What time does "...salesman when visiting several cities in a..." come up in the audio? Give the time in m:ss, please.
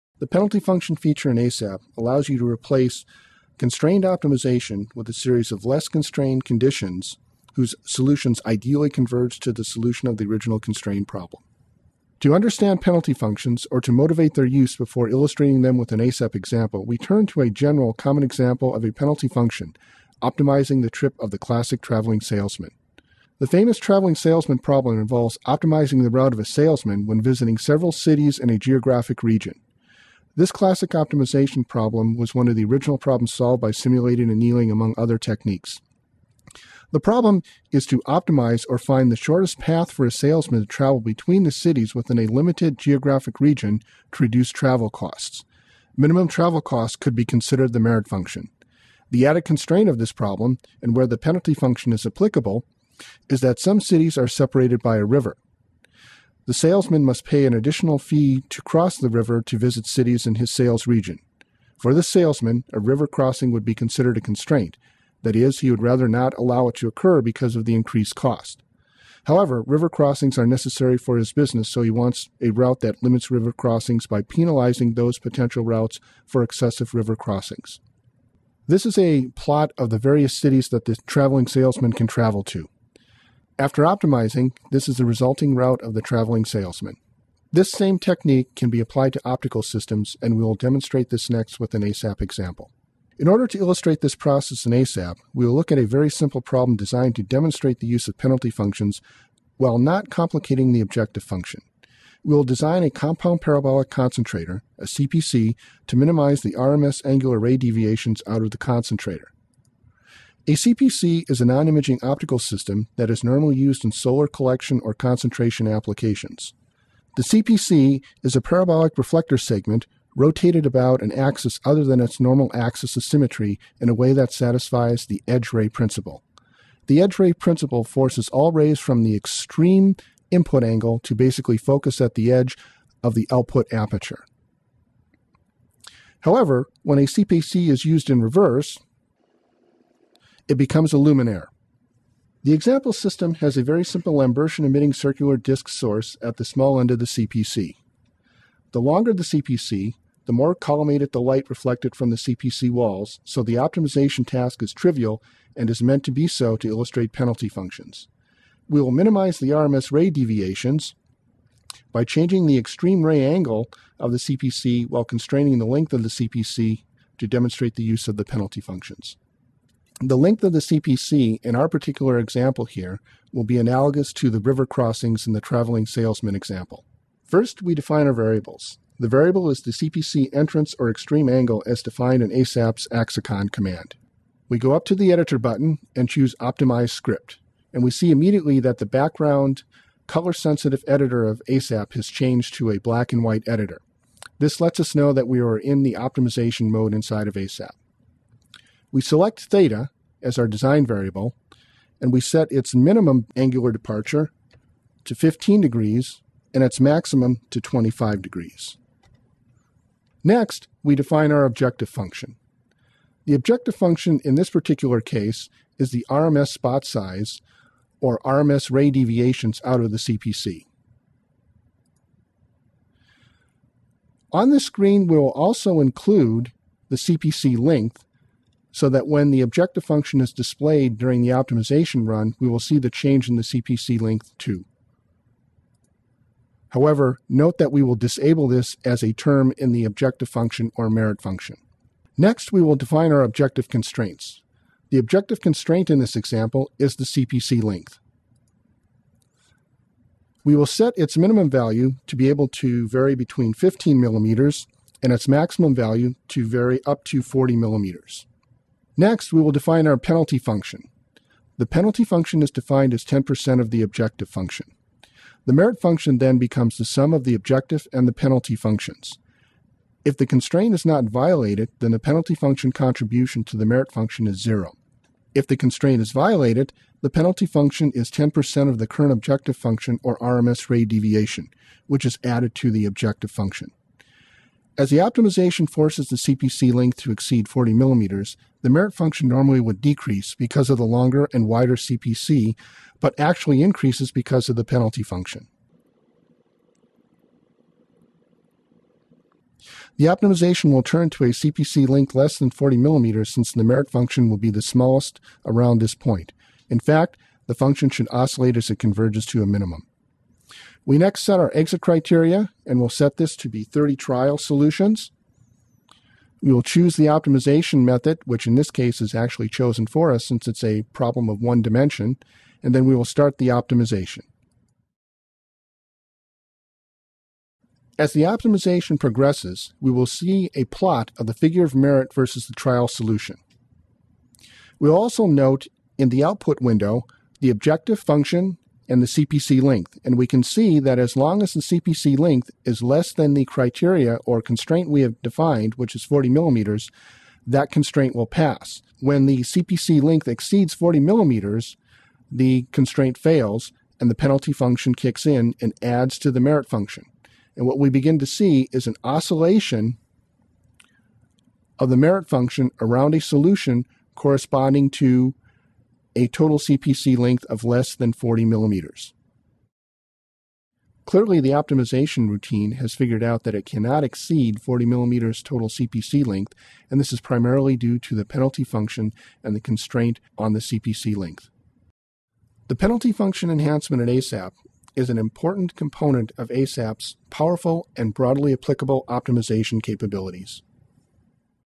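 0:26.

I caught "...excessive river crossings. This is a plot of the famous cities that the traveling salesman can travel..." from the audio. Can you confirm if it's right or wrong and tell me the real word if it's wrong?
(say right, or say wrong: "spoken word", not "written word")
wrong: "various", not "famous".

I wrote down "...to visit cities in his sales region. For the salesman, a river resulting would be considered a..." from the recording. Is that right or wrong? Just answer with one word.
wrong.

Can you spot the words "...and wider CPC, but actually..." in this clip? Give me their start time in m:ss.
4:51.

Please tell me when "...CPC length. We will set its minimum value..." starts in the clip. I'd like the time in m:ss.
4:07.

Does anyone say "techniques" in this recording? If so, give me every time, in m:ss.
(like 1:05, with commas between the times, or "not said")
0:35, 1:27.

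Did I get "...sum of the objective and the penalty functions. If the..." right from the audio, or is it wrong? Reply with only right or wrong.
right.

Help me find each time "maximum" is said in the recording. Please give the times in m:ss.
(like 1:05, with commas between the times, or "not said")
3:26, 4:15.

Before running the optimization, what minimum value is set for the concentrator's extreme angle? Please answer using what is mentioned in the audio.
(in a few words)
15 degrees.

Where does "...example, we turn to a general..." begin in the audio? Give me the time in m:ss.
0:16.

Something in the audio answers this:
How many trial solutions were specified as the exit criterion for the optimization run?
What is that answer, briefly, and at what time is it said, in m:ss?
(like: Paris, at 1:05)
30, at 5:13.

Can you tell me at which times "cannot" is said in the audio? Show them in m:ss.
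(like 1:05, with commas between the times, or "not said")
6:13.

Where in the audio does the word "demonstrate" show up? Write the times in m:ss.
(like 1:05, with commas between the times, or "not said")
1:30, 1:37, 2:47.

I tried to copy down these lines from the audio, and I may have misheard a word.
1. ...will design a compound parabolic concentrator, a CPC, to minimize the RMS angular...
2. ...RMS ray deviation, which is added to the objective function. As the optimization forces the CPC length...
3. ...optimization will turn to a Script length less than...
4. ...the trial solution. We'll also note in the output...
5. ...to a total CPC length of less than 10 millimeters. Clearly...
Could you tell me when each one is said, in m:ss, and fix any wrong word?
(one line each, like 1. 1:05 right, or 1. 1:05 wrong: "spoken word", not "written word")
1. 1:42 right
2. 4:40 right
3. 5:00 wrong: "CPC", not "Script"
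4. 5:32 right
5. 6:04 wrong: "40", not "10".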